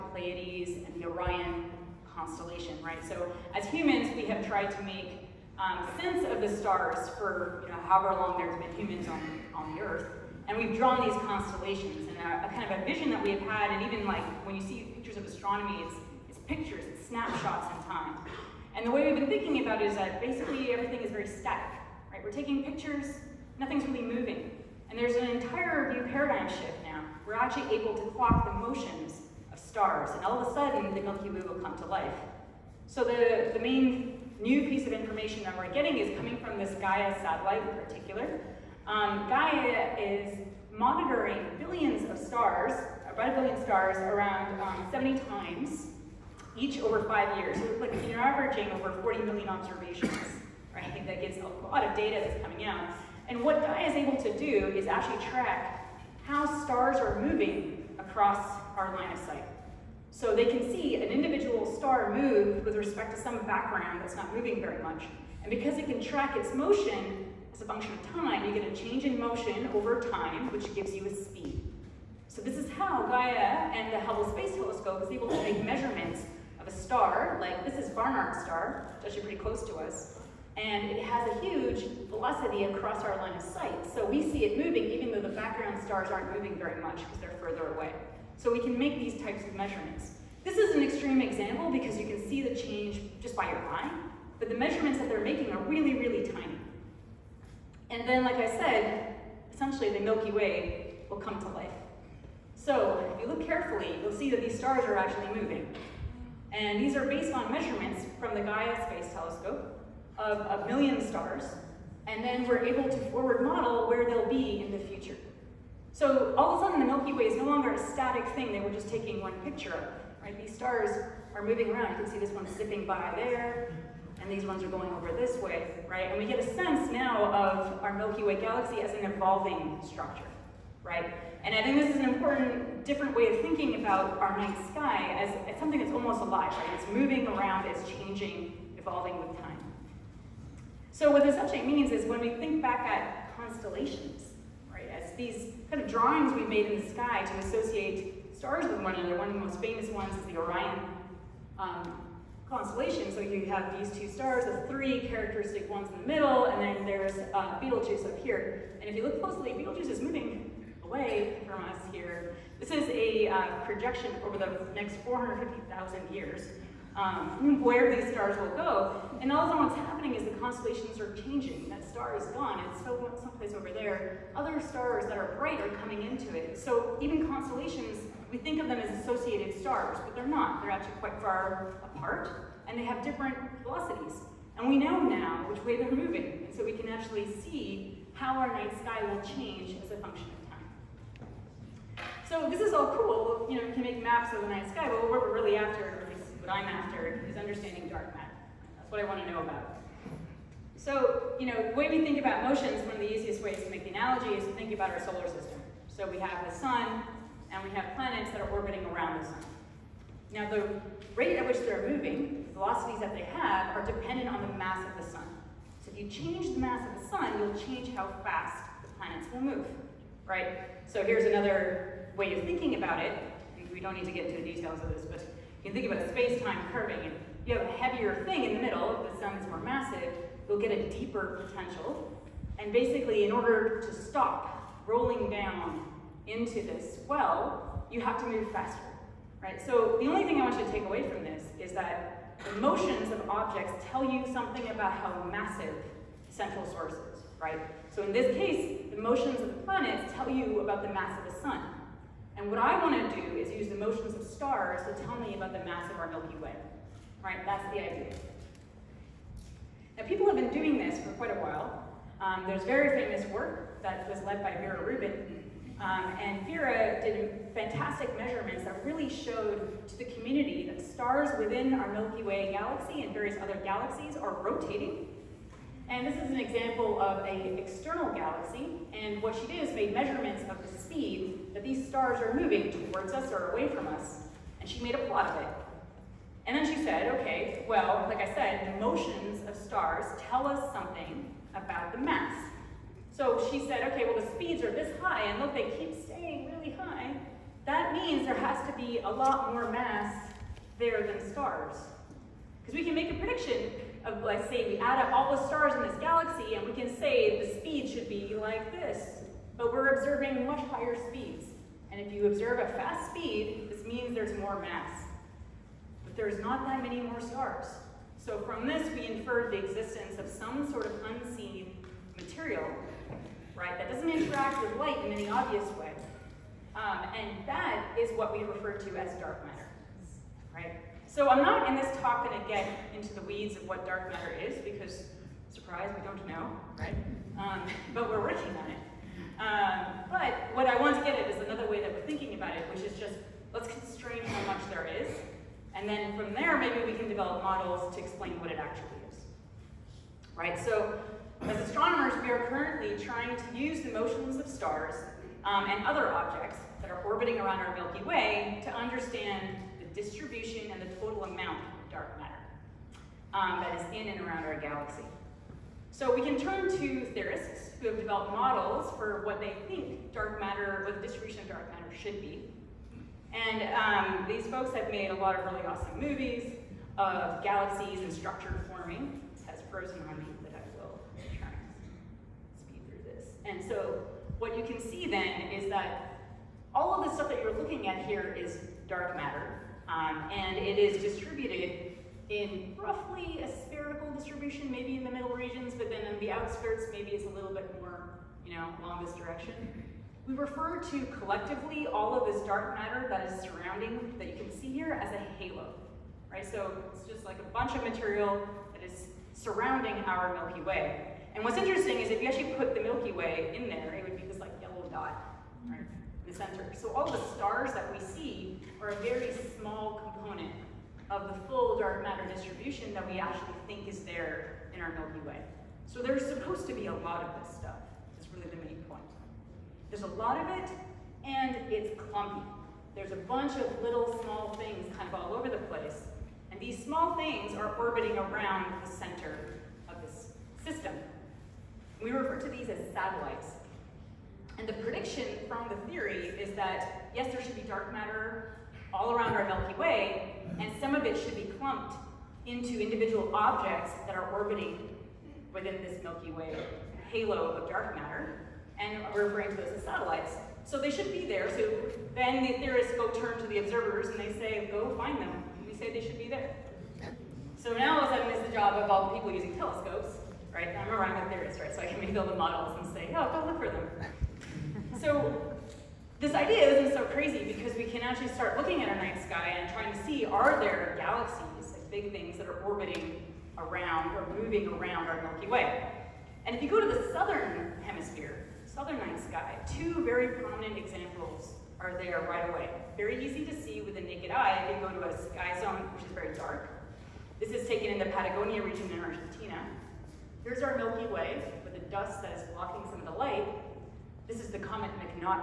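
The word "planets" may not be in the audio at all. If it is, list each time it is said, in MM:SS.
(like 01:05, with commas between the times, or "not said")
03:27, 03:38, 04:09.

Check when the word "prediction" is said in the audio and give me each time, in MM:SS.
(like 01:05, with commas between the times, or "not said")
05:03, 07:24.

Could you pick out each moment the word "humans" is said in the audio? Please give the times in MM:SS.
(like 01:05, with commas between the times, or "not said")
00:03, 00:08.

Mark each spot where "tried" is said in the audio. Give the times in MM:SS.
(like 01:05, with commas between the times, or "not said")
00:04.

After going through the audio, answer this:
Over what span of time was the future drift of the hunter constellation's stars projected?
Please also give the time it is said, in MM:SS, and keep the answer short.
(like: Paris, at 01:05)
450,000 years, at 02:45.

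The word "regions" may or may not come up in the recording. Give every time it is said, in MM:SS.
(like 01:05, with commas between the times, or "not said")
06:35, 08:18.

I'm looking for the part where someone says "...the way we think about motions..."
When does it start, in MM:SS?
03:21.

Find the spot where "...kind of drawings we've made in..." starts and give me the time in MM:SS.
02:25.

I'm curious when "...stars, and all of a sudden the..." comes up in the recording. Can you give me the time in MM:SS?
00:29.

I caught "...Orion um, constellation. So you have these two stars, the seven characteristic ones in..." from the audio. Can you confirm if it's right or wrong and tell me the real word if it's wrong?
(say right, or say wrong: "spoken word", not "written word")
wrong: "three", not "seven".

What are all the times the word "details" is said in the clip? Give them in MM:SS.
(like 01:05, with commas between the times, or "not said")
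03:44.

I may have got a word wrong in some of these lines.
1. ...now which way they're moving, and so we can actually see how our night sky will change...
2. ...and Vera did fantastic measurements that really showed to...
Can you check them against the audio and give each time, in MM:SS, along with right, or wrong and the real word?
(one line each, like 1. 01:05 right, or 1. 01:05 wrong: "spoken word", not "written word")
1. 03:05 right
2. 04:26 right.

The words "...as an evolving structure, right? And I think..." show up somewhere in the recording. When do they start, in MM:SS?
02:08.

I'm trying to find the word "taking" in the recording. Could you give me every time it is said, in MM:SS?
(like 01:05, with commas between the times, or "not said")
00:22, 01:58.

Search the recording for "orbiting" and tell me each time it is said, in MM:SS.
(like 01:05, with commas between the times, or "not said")
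03:28, 05:57, 07:17, 07:34, 08:02.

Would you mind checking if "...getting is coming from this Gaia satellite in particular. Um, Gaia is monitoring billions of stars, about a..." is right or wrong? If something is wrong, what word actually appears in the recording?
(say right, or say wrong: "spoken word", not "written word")
right.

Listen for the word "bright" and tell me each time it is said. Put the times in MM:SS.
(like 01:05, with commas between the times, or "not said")
02:55.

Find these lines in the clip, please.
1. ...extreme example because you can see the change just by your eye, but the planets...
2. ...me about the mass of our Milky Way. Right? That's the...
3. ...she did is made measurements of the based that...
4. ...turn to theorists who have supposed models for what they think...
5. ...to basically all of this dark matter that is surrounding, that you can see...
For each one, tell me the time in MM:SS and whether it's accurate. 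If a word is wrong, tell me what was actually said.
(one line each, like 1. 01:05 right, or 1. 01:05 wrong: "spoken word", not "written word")
1. 01:30 wrong: "measurements", not "planets"
2. 04:15 right
3. 04:39 wrong: "speed", not "based"
4. 06:06 wrong: "developed", not "supposed"
5. 06:40 wrong: "collectively", not "basically".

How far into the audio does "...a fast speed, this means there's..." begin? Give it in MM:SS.
05:12.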